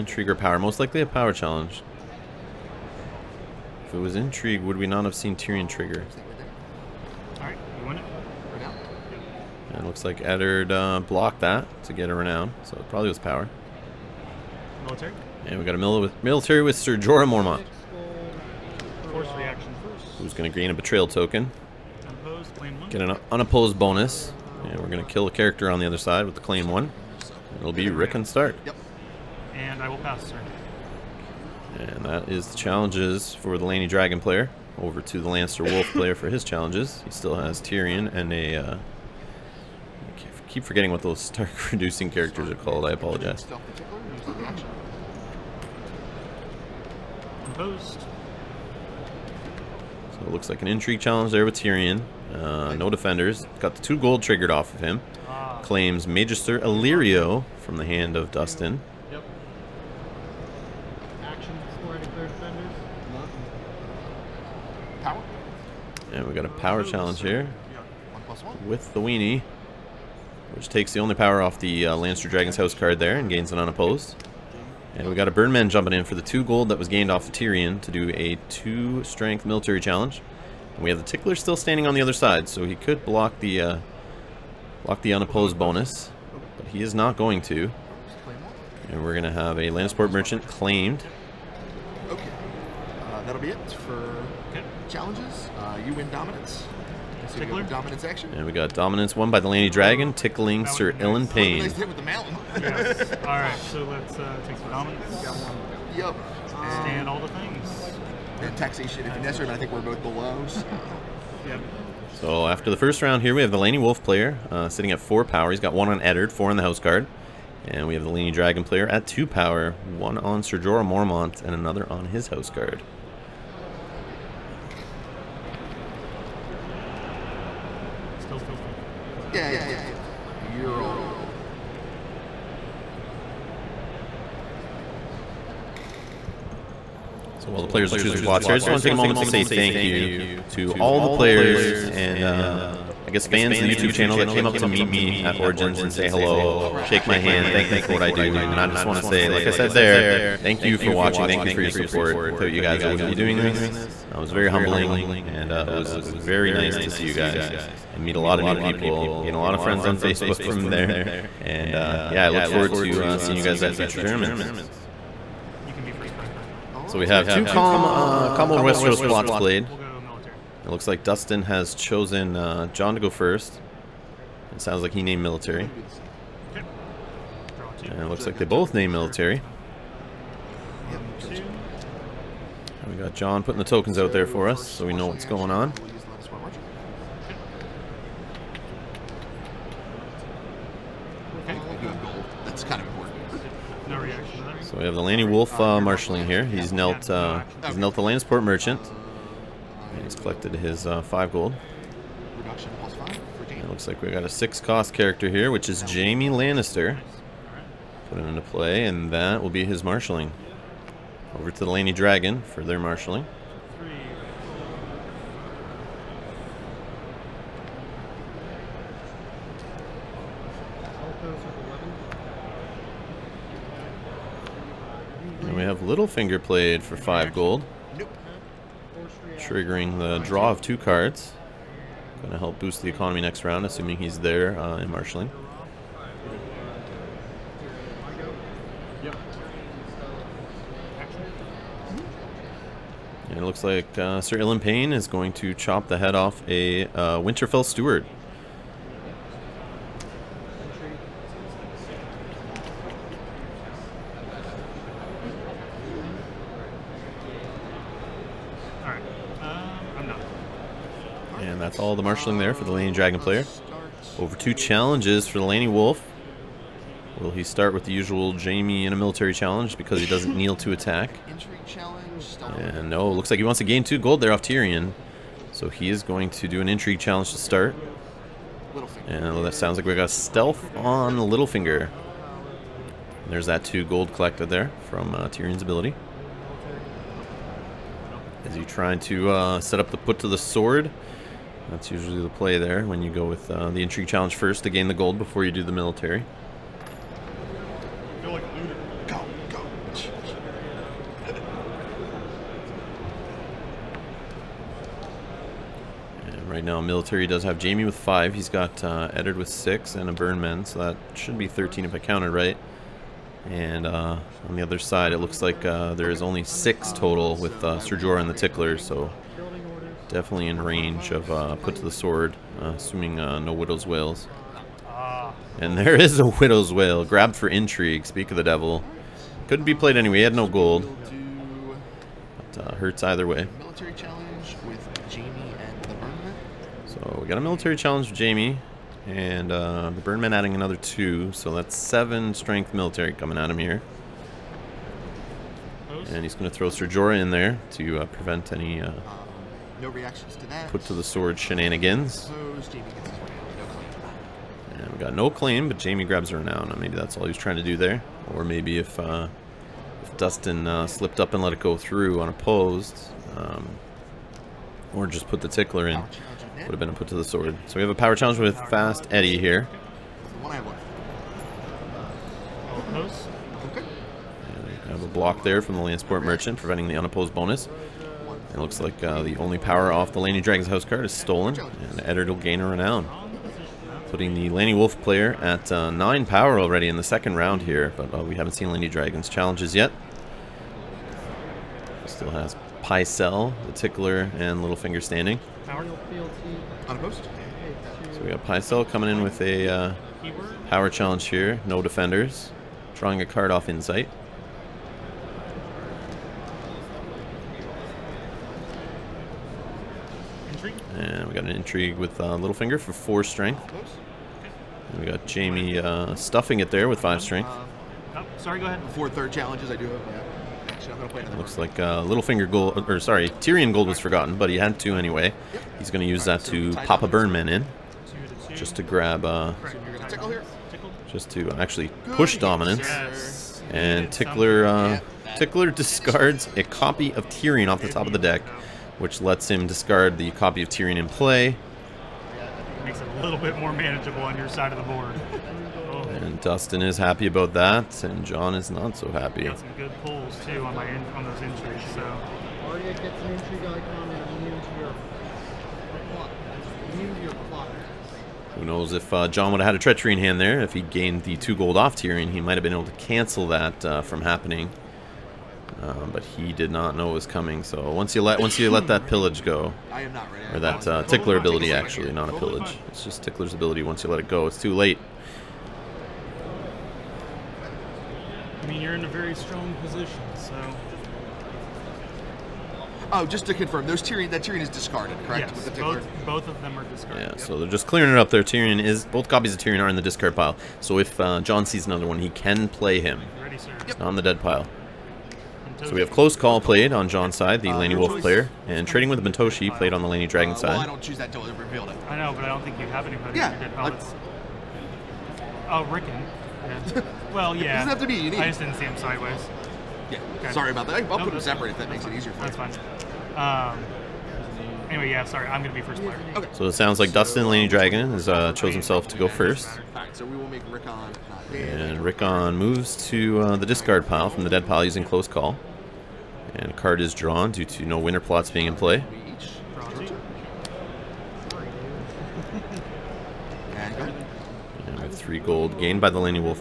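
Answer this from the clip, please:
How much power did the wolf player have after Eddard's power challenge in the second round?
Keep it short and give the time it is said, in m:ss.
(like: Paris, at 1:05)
9, at 6:25.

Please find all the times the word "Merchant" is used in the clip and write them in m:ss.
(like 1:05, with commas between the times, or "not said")
1:30, 3:18, 6:16.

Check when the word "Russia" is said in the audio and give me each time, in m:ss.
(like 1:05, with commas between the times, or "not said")
not said.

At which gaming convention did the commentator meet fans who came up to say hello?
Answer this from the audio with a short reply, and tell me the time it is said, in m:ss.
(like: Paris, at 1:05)
Origins, at 2:25.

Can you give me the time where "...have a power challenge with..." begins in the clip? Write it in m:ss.
6:07.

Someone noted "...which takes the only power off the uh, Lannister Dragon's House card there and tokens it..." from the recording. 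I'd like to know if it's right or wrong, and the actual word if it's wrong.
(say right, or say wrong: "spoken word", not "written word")
wrong: "gains", not "tokens".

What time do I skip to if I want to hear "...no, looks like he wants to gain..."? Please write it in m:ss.
4:32.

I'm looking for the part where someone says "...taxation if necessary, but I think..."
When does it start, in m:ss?
1:48.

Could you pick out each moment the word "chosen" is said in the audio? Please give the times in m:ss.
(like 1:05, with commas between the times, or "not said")
2:51.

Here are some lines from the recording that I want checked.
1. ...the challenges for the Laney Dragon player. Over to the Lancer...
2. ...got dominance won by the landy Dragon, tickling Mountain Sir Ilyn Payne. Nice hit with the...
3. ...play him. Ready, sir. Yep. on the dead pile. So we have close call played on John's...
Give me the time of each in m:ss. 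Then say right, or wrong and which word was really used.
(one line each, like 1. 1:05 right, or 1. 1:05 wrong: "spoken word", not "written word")
1. 0:32 right
2. 1:38 right
3. 8:12 right.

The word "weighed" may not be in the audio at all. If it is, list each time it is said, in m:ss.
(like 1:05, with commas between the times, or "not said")
not said.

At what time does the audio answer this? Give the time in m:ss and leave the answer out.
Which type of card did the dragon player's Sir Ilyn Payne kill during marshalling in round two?
4:07.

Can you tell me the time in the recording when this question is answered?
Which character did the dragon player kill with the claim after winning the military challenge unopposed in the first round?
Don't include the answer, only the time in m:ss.
0:27.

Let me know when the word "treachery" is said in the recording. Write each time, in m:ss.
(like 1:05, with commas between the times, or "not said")
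7:39.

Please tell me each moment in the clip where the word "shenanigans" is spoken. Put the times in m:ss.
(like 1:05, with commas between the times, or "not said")
5:51.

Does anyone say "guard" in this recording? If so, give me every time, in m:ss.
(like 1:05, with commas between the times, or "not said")
1:56, 2:02.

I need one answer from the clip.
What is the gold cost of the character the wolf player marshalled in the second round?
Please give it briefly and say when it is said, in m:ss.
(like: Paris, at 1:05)
6, at 3:24.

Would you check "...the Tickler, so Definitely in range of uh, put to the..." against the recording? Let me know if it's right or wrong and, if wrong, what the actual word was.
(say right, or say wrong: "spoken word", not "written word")
right.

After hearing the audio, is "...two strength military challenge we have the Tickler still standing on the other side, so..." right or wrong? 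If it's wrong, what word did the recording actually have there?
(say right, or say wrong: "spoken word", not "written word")
right.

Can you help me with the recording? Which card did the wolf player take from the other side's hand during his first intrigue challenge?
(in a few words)
Magister Illyrio.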